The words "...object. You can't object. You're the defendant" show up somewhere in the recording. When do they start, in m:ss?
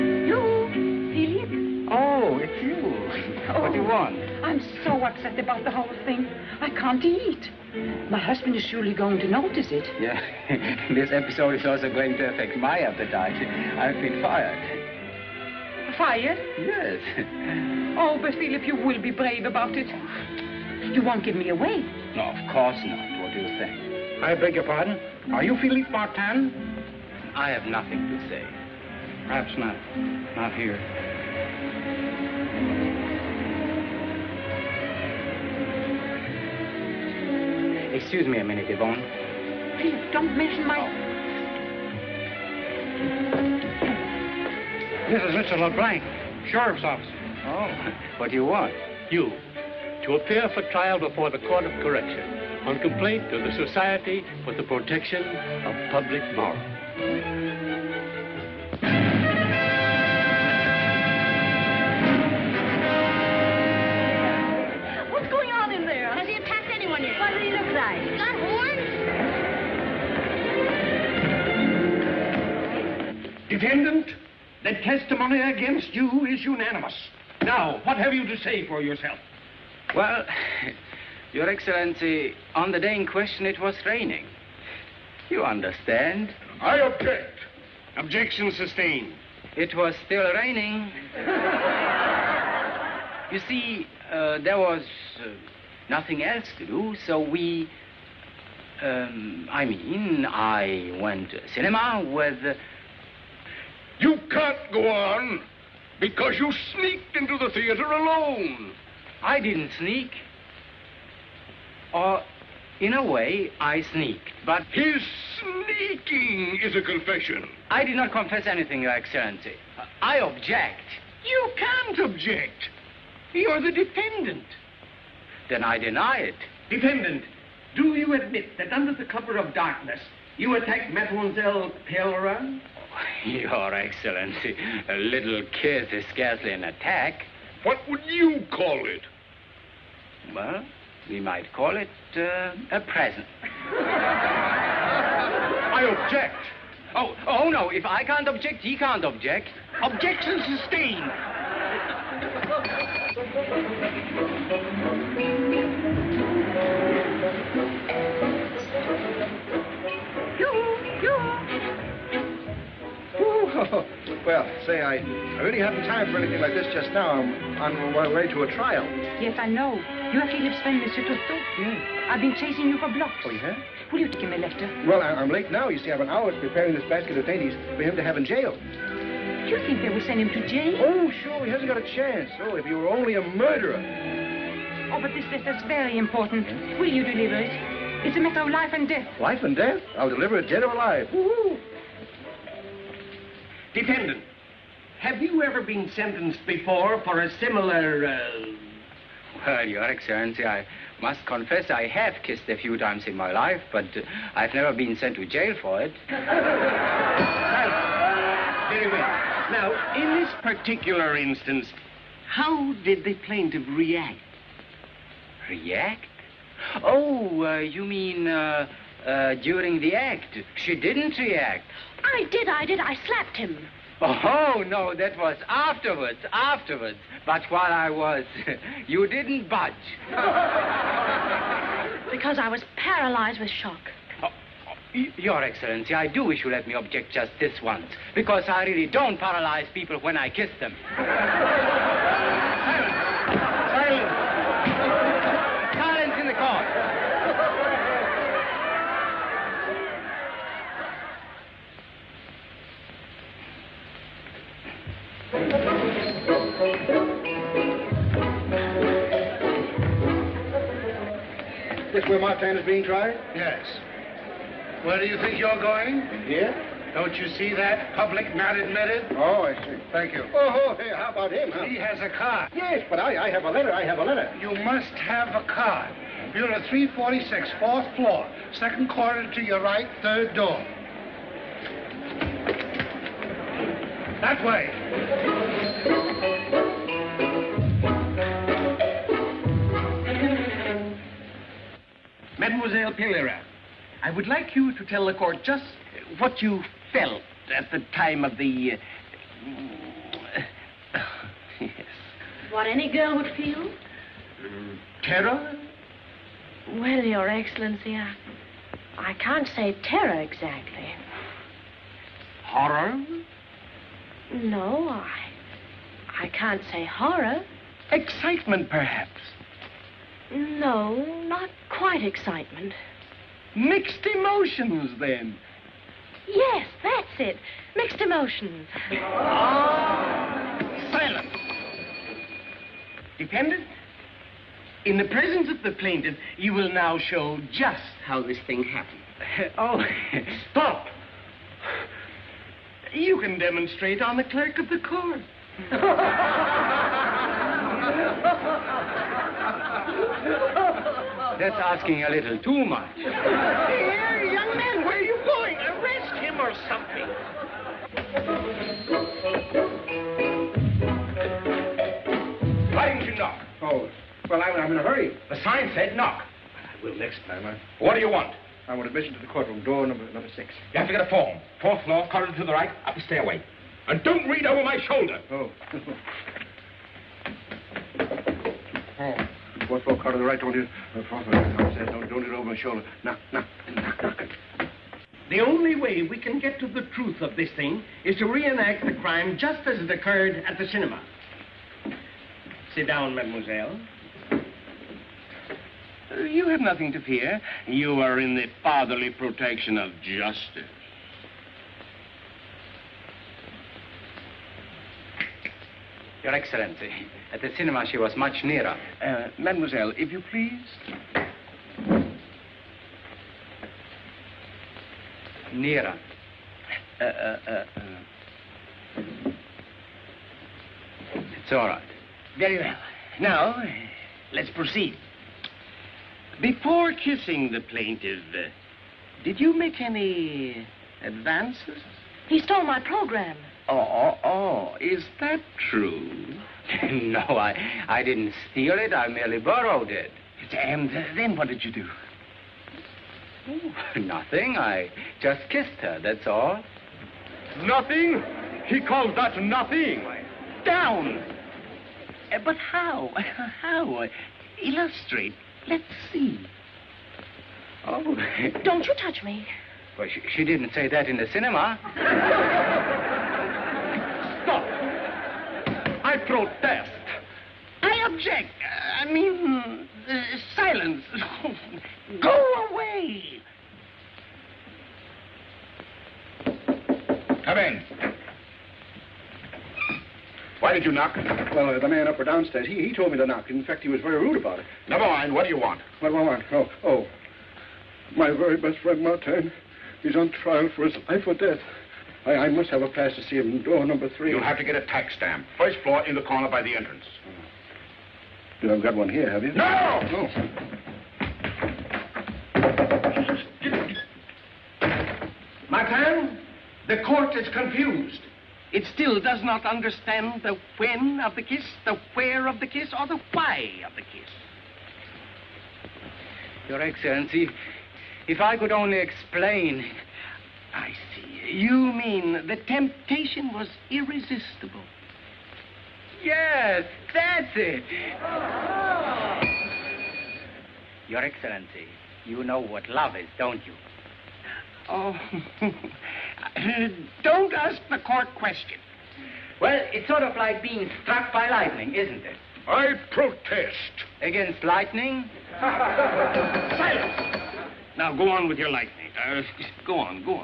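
2:00.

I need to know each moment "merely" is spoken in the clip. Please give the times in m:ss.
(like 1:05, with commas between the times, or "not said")
7:19.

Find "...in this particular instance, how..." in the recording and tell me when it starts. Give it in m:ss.
3:29.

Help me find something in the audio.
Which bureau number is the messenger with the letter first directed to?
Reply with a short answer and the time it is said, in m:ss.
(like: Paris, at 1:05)
346, at 4:36.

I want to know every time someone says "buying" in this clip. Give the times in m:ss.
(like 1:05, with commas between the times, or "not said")
not said.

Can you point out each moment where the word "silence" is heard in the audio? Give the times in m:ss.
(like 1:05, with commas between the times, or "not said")
5:30, 7:50, 9:05.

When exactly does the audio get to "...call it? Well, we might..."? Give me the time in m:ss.
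2:18.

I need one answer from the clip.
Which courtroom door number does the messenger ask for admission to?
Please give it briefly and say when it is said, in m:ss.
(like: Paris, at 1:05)
Number six, at 6:10.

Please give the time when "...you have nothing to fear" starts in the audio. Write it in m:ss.
6:36.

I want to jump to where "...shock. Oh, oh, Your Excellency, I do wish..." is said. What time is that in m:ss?
3:53.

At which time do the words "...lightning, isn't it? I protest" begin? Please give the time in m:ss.
9:01.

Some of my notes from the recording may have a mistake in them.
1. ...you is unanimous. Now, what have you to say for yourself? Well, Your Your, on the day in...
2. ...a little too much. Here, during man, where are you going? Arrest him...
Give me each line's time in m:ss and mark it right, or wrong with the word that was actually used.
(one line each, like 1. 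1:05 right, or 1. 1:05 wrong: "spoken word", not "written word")
1. 1:15 wrong: "Excellency", not "Your"
2. 5:52 wrong: "young", not "during".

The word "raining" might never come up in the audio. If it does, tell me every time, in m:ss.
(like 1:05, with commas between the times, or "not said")
1:23, 1:30.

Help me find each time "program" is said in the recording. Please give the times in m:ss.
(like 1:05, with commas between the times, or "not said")
7:12.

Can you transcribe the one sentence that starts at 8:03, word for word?
In fact, he was very rude about it.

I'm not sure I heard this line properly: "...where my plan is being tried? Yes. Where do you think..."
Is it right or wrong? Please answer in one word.
right.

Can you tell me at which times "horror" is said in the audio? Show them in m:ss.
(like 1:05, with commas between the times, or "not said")
5:12, 5:16.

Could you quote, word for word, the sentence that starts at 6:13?
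And don't read over my shoulder.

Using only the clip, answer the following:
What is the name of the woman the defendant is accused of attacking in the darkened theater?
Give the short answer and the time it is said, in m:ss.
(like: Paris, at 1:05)
Mademoiselle Pellerin, at 2:10.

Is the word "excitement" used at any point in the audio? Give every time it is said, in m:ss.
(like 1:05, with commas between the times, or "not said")
5:17, 5:22.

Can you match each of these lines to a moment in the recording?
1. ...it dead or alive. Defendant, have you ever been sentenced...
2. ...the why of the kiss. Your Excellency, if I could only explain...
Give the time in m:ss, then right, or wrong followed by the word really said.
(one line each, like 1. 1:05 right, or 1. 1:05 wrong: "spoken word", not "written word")
1. 3:10 right
2. 8:33 right.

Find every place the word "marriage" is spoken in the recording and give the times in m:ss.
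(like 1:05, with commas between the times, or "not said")
not said.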